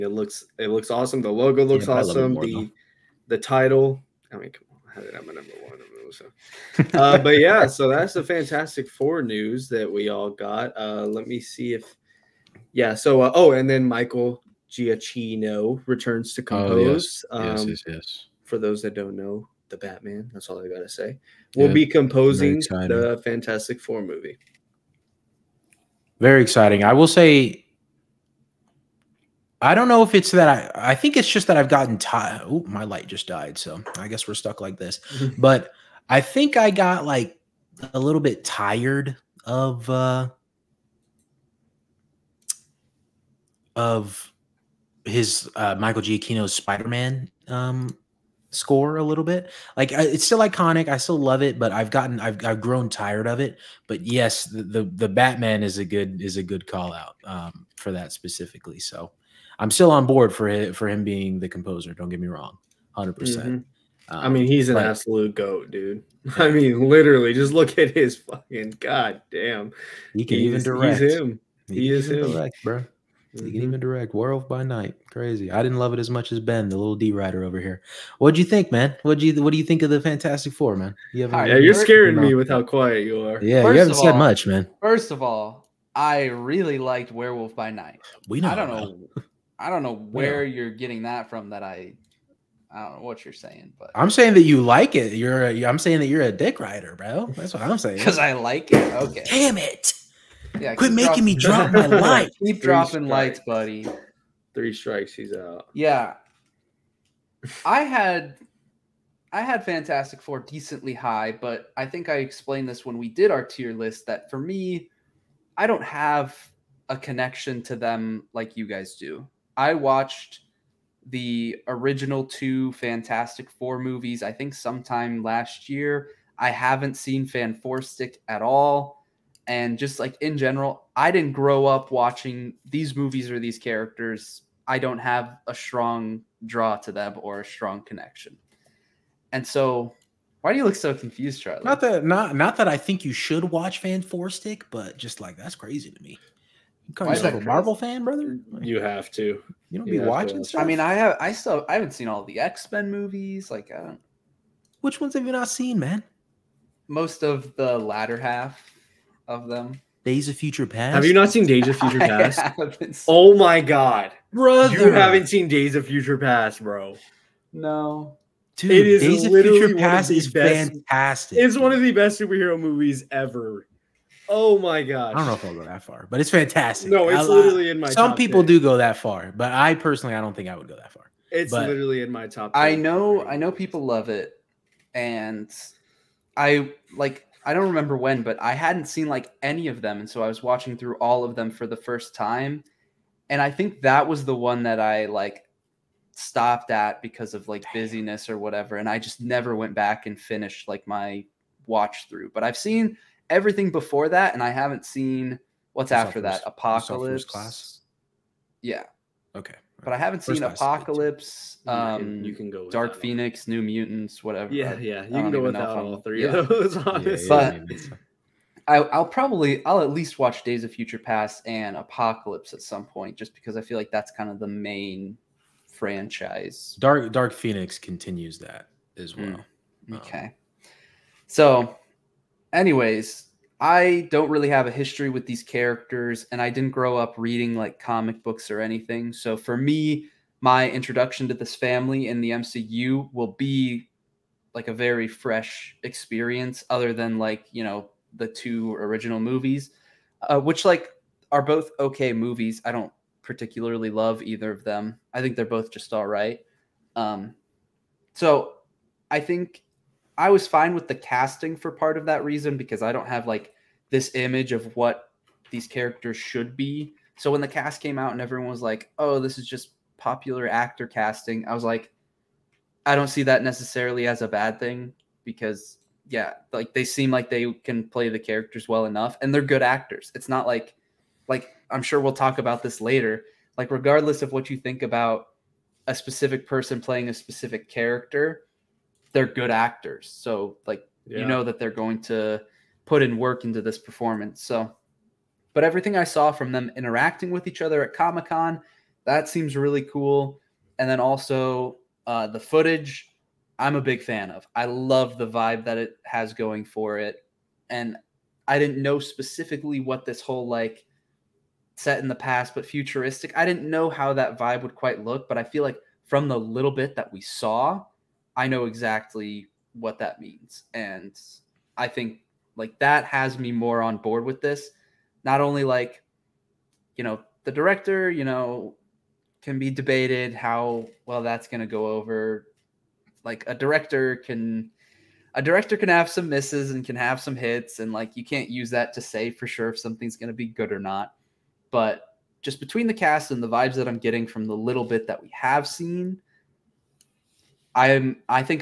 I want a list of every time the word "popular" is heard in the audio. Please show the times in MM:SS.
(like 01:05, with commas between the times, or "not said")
04:29.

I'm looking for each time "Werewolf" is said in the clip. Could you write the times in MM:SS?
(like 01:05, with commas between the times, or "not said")
01:14, 01:27.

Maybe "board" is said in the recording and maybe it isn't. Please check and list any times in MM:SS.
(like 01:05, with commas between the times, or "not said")
01:00, 05:23.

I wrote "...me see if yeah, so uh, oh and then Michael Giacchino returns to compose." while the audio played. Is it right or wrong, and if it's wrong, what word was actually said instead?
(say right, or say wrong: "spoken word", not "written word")
right.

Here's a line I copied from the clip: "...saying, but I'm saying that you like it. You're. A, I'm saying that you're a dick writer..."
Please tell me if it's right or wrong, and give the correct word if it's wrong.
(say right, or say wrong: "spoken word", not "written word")
right.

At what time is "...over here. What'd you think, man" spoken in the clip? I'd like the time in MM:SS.
01:17.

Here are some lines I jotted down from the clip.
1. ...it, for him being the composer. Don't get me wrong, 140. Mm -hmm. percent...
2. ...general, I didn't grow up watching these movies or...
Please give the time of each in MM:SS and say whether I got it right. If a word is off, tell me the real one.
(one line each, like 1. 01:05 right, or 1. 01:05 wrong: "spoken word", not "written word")
1. 01:00 wrong: "100", not "140"
2. 02:10 right.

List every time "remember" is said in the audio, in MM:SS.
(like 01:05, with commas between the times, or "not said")
03:07.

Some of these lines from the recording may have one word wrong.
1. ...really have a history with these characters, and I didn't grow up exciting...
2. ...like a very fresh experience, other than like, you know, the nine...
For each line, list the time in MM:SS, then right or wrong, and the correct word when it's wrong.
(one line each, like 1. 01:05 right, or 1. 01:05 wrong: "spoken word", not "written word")
1. 03:54 wrong: "reading", not "exciting"
2. 04:04 wrong: "two", not "nine".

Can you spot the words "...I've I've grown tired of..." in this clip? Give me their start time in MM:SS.
00:52.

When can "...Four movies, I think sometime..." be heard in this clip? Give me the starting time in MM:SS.
02:03.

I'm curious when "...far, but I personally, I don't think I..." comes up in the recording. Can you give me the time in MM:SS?
02:58.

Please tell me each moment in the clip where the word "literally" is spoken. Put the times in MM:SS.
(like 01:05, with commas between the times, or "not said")
01:06, 02:57, 03:01.